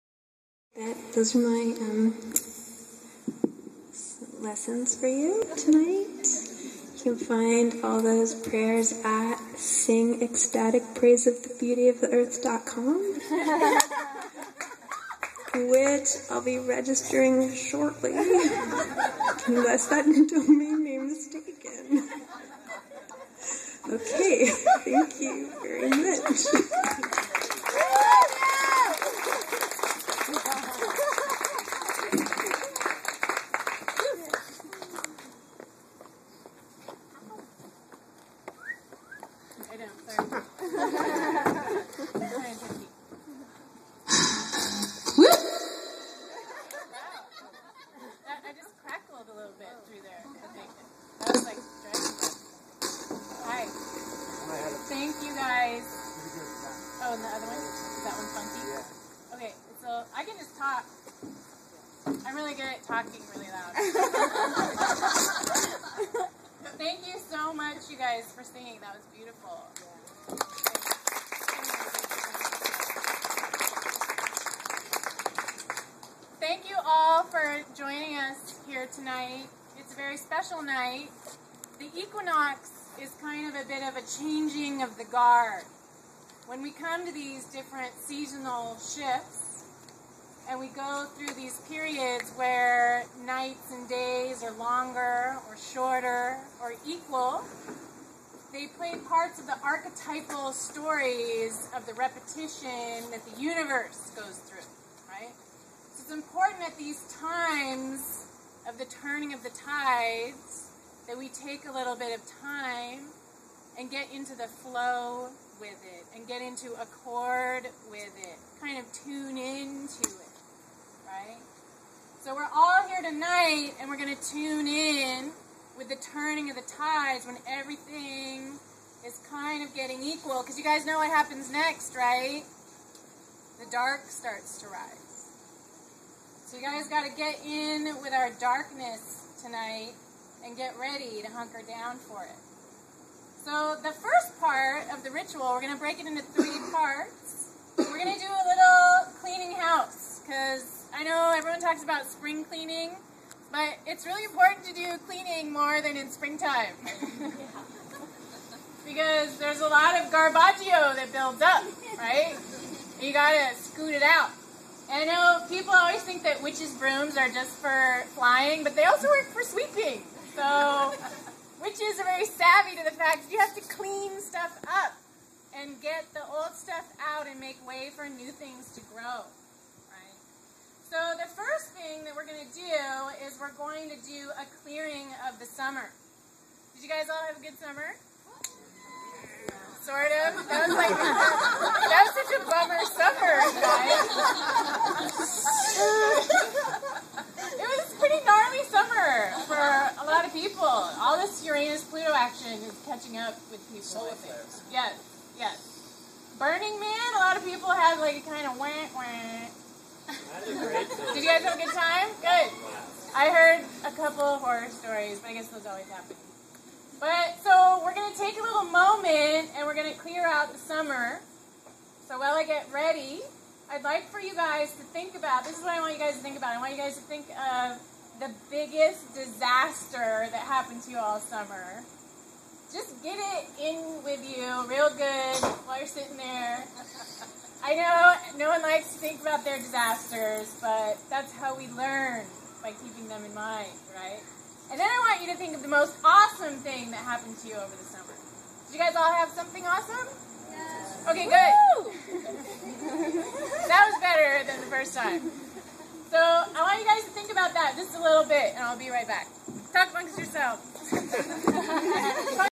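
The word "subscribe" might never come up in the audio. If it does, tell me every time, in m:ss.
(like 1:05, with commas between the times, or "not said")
not said.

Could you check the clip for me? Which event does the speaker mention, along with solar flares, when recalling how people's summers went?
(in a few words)
Burning Man.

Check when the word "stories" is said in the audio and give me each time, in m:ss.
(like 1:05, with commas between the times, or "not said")
1:40, 3:34.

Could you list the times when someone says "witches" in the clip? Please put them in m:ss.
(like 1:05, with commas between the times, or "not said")
2:46, 2:51.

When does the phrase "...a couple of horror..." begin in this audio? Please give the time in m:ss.
3:33.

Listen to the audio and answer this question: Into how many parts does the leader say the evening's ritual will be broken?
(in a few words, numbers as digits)
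3.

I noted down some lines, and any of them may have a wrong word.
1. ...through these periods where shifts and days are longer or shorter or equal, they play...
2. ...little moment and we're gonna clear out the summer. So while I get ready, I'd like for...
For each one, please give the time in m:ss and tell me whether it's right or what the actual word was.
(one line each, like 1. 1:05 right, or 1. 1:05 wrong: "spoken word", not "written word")
1. 1:31 wrong: "nights", not "shifts"
2. 3:38 right.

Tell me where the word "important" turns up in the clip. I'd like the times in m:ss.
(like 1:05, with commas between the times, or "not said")
1:46, 2:34.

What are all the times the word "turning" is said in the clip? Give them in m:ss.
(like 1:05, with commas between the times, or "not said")
1:48, 2:06.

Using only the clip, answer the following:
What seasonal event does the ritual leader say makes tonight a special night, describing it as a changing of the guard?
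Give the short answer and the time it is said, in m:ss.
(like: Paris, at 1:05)
The equinox, at 1:21.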